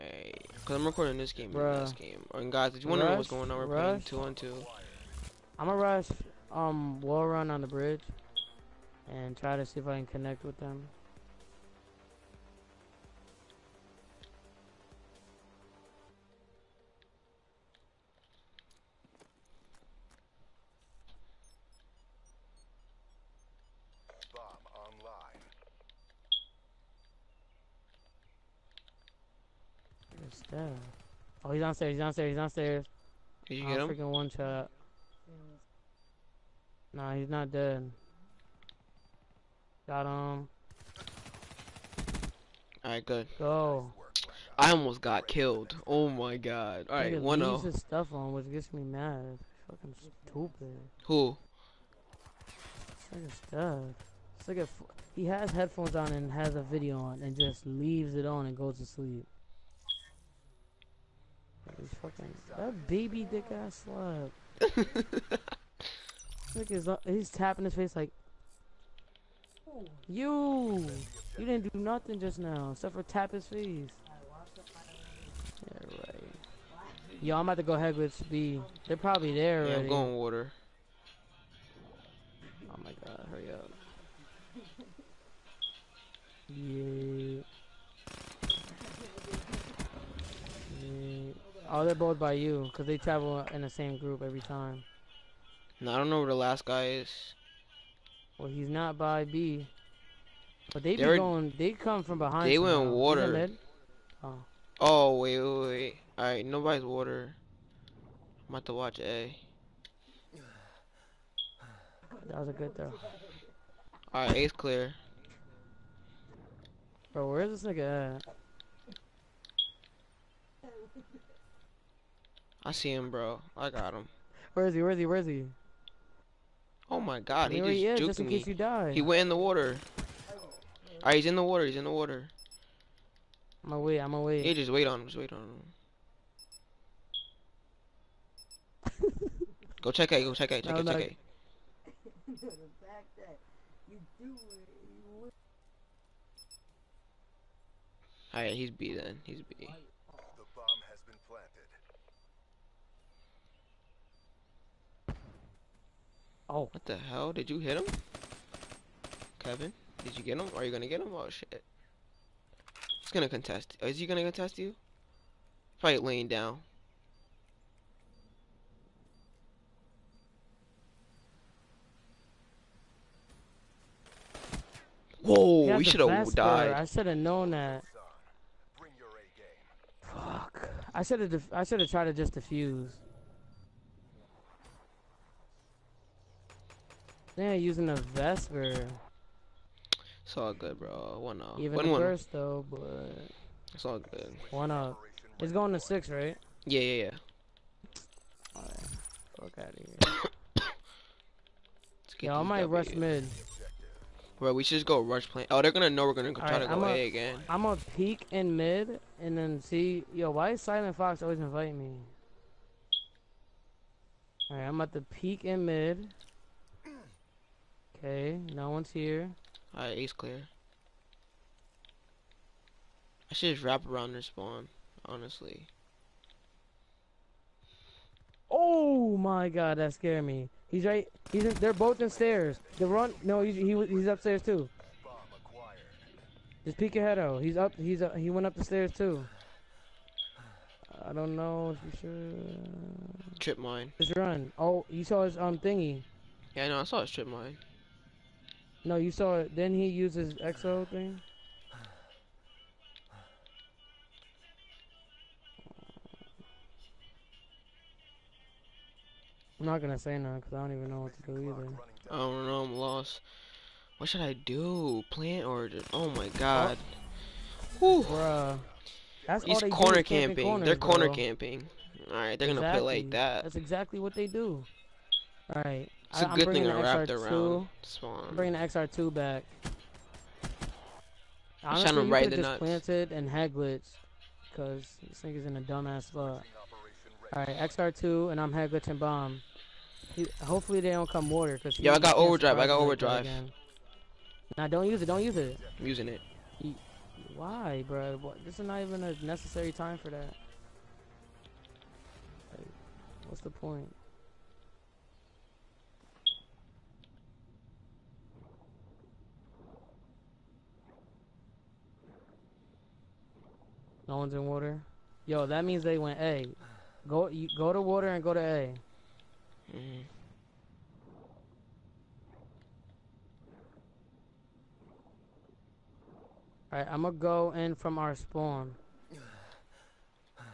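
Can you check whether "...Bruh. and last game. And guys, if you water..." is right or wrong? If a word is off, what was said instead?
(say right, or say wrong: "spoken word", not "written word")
wrong: "wonder", not "water".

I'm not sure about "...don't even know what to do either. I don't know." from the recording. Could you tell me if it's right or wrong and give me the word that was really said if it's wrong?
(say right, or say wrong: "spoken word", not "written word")
right.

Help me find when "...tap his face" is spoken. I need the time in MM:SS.
01:13.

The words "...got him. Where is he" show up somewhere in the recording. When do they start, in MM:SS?
02:03.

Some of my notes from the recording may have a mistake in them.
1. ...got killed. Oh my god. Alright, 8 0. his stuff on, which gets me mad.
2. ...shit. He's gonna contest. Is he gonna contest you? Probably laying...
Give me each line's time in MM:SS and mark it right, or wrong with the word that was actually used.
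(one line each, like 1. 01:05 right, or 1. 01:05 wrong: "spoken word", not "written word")
1. 00:44 wrong: "1", not "8"
2. 02:41 right.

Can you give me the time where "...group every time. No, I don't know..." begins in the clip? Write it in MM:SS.
01:33.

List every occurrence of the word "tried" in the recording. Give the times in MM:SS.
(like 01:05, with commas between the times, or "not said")
03:01.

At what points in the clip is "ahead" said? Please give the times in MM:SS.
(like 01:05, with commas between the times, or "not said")
01:17.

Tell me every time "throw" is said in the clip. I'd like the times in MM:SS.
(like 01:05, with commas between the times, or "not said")
01:52.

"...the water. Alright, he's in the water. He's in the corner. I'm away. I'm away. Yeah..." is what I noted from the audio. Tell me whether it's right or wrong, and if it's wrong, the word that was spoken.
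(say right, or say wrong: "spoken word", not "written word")
wrong: "water", not "corner".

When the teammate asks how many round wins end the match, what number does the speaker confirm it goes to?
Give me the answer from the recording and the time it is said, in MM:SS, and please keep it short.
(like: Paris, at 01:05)
6, at 03:15.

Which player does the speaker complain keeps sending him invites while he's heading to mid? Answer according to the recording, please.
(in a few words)
Silent Fox.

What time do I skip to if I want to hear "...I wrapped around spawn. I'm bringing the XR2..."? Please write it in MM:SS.
04:36.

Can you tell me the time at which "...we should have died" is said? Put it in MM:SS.
02:55.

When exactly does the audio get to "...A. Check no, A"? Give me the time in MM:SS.
02:20.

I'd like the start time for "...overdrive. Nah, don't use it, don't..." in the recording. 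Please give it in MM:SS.
04:52.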